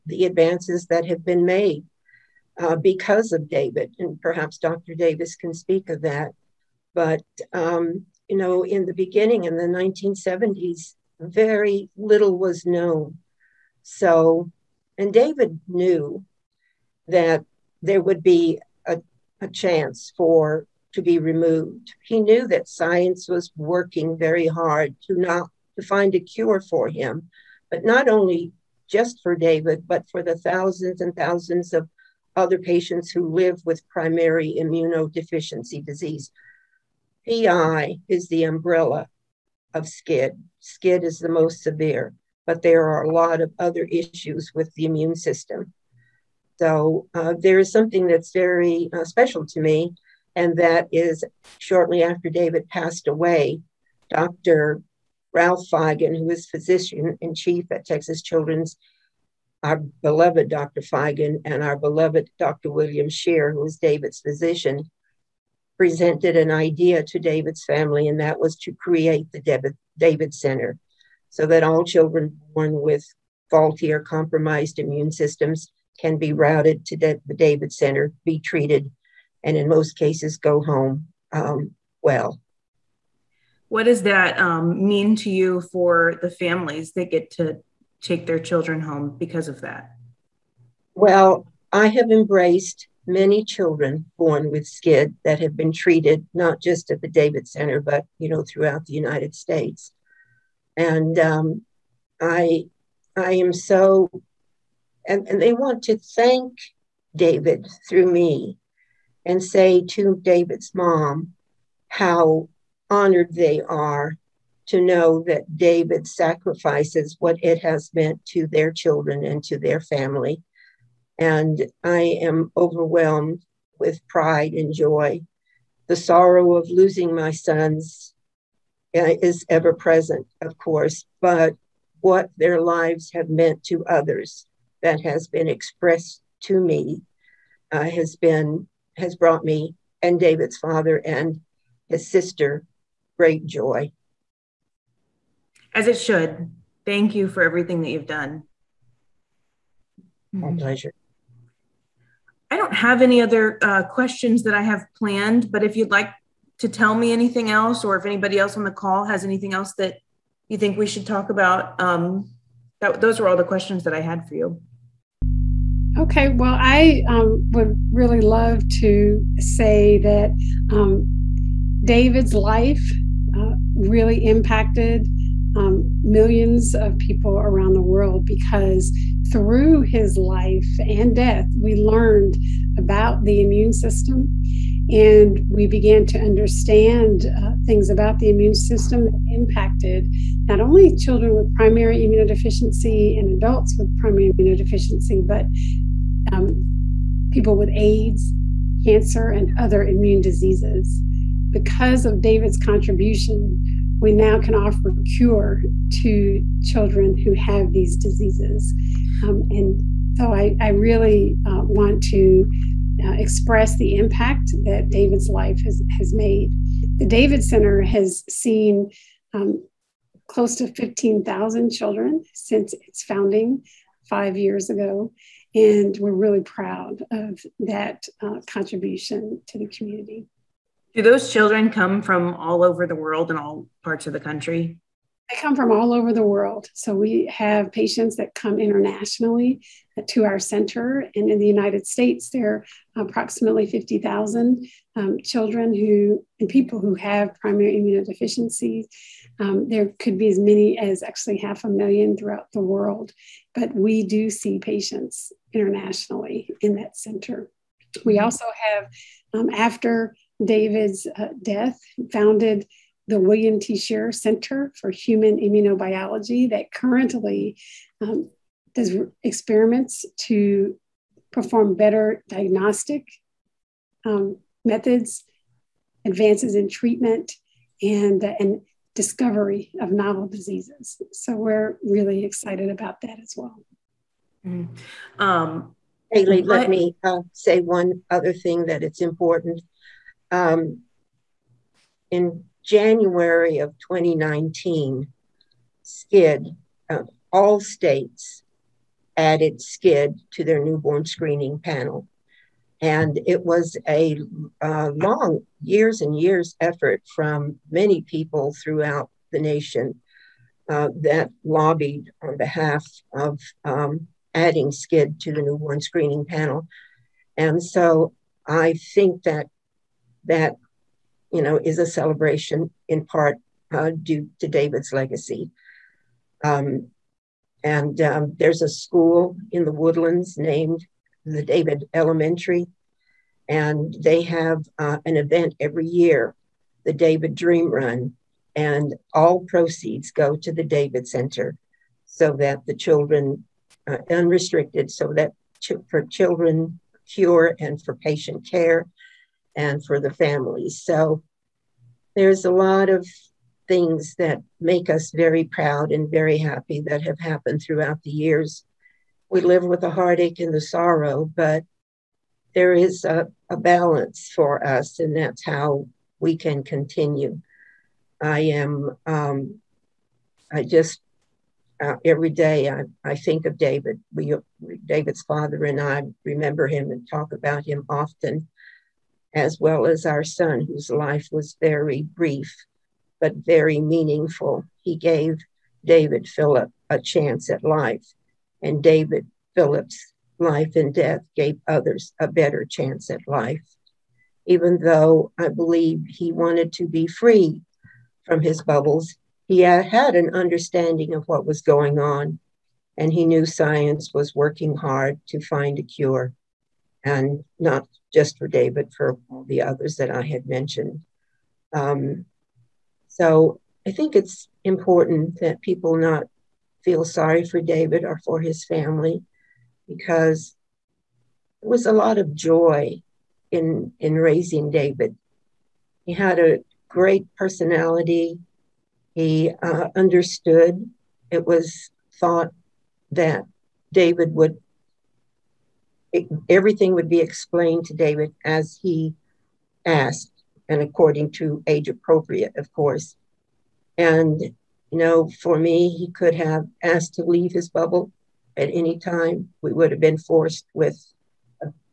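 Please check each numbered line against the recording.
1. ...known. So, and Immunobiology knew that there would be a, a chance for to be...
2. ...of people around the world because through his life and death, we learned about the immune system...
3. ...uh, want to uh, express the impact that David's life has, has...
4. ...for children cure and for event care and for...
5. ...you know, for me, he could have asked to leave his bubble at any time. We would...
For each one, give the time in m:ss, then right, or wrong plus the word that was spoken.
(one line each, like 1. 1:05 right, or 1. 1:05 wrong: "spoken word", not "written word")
1. 0:12 wrong: "David", not "Immunobiology"
2. 2:56 right
3. 3:31 right
4. 5:45 wrong: "patient", not "event"
5. 7:24 right.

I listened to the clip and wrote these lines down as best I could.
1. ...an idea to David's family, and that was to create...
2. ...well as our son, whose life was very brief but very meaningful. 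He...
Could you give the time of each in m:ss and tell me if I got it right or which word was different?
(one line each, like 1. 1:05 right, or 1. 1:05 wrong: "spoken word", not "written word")
1. 1:06 right
2. 6:19 right.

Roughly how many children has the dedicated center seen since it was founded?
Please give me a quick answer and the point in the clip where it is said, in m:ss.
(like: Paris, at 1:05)
15,000, at 3:40.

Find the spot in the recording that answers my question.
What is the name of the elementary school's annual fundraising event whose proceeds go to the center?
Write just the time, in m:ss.
5:36.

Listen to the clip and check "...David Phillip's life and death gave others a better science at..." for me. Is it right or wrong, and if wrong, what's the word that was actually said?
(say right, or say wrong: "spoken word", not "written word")
wrong: "chance", not "science".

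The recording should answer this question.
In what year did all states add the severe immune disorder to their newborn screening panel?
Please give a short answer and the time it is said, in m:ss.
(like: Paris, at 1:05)
2019, at 4:53.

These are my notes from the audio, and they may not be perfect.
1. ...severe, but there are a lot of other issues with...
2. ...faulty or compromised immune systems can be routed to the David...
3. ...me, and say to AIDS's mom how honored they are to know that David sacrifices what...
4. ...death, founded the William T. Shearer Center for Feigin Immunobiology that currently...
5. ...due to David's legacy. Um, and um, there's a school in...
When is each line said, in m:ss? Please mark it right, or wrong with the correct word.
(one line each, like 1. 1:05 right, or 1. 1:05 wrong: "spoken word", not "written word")
1. 0:41 right
2. 1:13 right
3. 1:48 wrong: "David", not "AIDS"
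4. 4:21 wrong: "Human", not "Feigin"
5. 5:24 right.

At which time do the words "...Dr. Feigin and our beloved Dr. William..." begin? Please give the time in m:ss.
1:00.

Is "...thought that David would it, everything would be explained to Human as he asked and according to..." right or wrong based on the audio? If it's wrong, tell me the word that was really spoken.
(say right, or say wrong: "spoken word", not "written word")
wrong: "David", not "Human".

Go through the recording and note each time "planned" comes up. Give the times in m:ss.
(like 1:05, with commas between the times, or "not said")
2:34.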